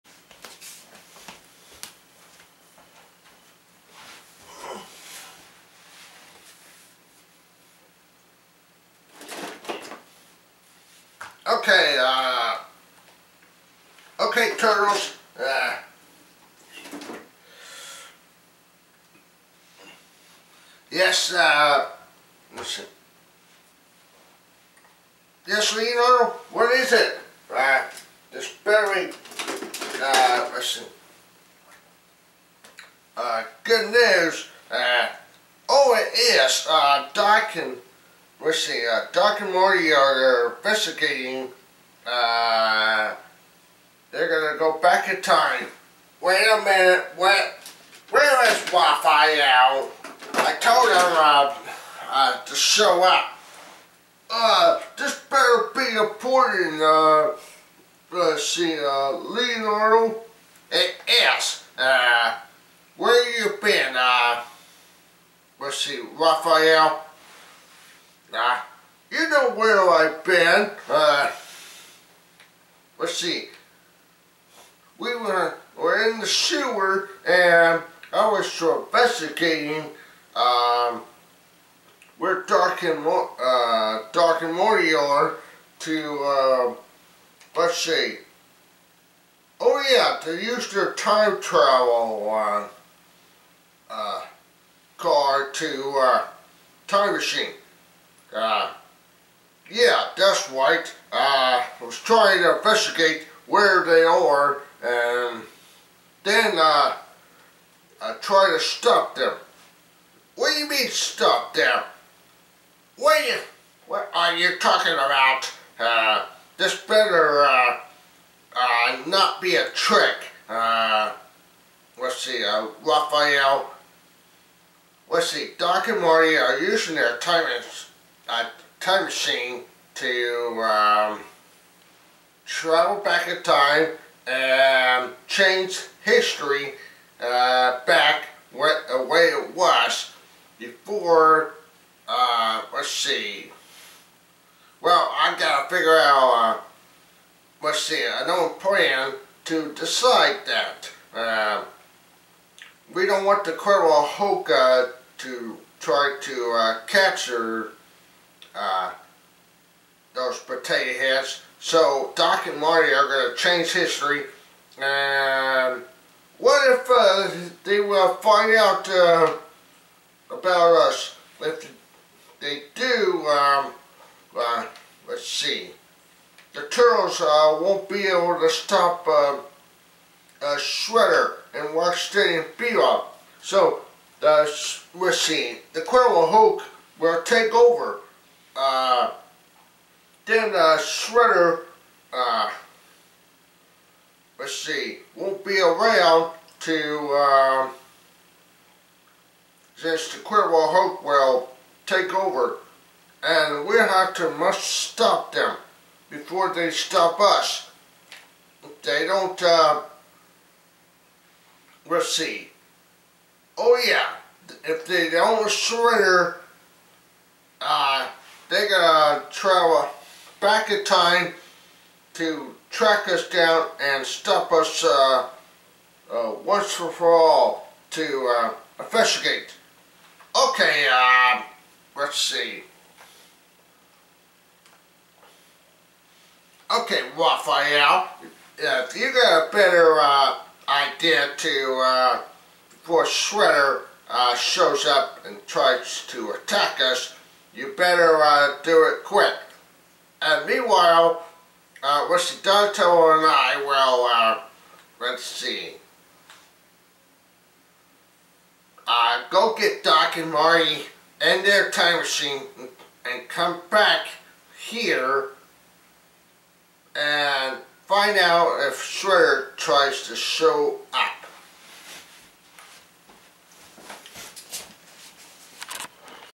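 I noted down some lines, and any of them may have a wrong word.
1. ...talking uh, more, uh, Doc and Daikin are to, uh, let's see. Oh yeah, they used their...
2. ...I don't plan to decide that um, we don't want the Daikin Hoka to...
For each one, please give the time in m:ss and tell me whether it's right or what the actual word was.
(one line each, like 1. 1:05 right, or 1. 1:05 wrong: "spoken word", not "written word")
1. 1:22 wrong: "Marty", not "Daikin"
2. 2:28 wrong: "Colonel", not "Daikin".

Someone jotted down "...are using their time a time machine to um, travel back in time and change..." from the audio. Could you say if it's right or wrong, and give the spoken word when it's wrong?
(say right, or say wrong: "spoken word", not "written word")
right.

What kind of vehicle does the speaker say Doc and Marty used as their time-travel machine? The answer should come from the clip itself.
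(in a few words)
car.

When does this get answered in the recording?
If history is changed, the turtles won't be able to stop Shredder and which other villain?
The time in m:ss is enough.
3:01.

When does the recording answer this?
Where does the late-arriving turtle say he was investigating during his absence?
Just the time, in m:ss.
1:16.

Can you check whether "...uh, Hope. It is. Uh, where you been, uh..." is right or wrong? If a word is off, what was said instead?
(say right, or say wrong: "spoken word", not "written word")
wrong: "Leonardo", not "Hope".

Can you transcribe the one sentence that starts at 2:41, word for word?
So Doc and Marty are going to change history.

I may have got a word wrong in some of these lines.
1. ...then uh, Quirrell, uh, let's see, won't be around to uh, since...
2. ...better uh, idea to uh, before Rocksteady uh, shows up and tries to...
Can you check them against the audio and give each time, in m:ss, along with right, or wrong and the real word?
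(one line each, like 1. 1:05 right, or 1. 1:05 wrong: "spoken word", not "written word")
1. 3:10 wrong: "Shredder", not "Quirrell"
2. 3:59 wrong: "Shredder", not "Rocksteady".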